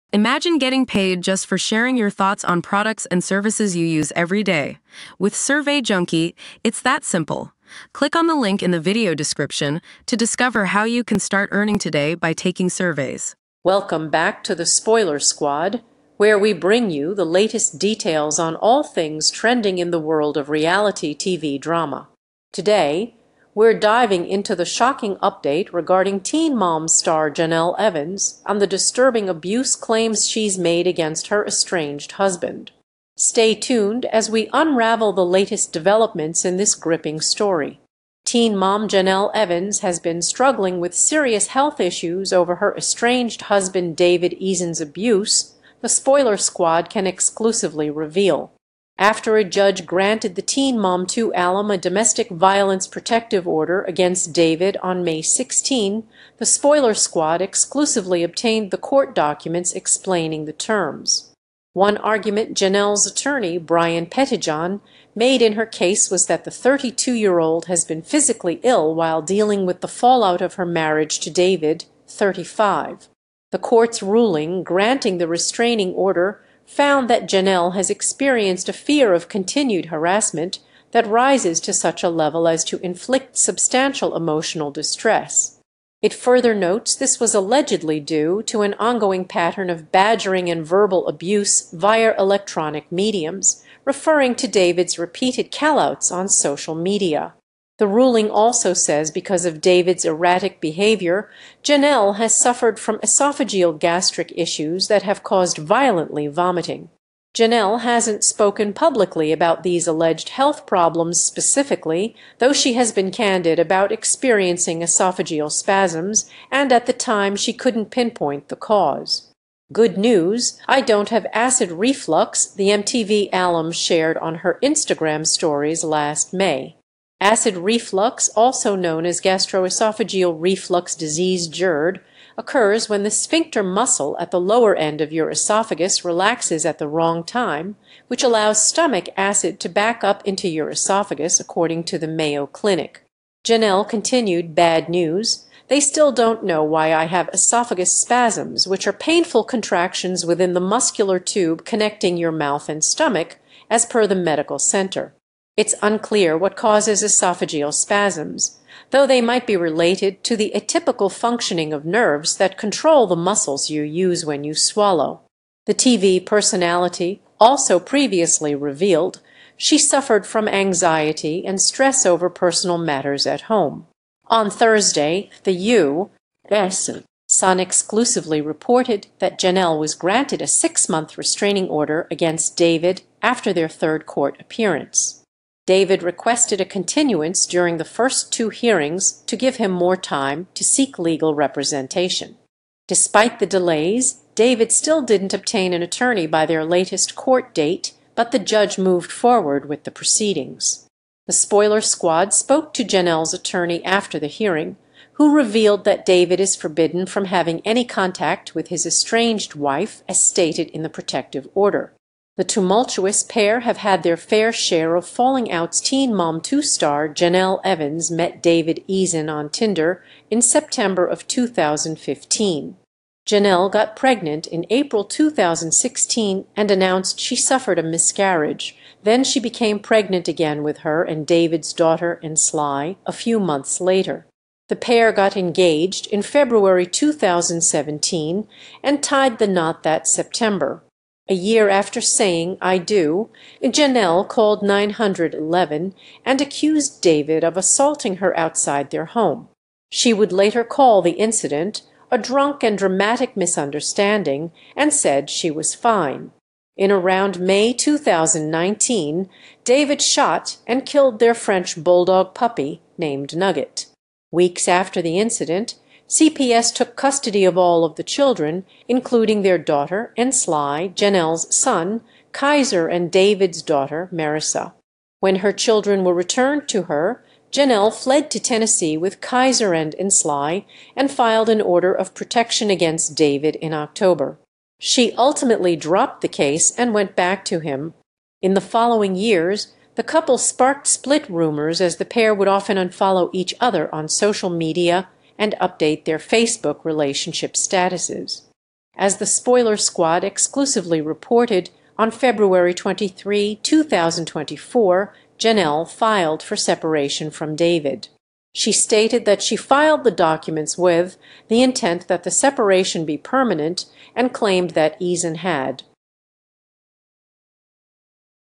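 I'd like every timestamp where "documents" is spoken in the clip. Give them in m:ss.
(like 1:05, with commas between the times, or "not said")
0:59, 5:10.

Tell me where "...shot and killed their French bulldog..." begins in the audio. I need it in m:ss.
4:20.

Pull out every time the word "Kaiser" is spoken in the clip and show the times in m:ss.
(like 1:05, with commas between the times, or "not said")
4:32, 4:39.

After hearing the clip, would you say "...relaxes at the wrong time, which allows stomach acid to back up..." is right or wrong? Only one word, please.
right.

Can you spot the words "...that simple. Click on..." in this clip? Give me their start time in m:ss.
0:06.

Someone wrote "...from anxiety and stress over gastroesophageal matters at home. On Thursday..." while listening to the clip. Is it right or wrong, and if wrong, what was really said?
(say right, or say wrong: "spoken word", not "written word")
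wrong: "personal", not "gastroesophageal".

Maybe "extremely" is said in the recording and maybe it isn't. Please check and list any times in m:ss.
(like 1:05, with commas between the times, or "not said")
not said.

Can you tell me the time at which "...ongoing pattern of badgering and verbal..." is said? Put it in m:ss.
1:28.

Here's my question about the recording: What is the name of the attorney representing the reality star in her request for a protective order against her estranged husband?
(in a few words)
Brian Pettijohn.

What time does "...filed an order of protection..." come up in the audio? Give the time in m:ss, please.
4:41.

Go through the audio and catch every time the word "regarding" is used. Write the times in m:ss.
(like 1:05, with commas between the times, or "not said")
0:25.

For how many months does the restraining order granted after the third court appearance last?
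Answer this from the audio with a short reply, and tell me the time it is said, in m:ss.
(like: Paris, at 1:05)
6, at 3:00.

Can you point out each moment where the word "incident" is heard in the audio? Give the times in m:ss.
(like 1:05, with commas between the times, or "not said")
4:11, 4:25.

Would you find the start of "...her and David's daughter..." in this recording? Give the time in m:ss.
3:50.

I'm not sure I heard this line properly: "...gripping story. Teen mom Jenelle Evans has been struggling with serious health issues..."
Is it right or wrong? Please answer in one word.
right.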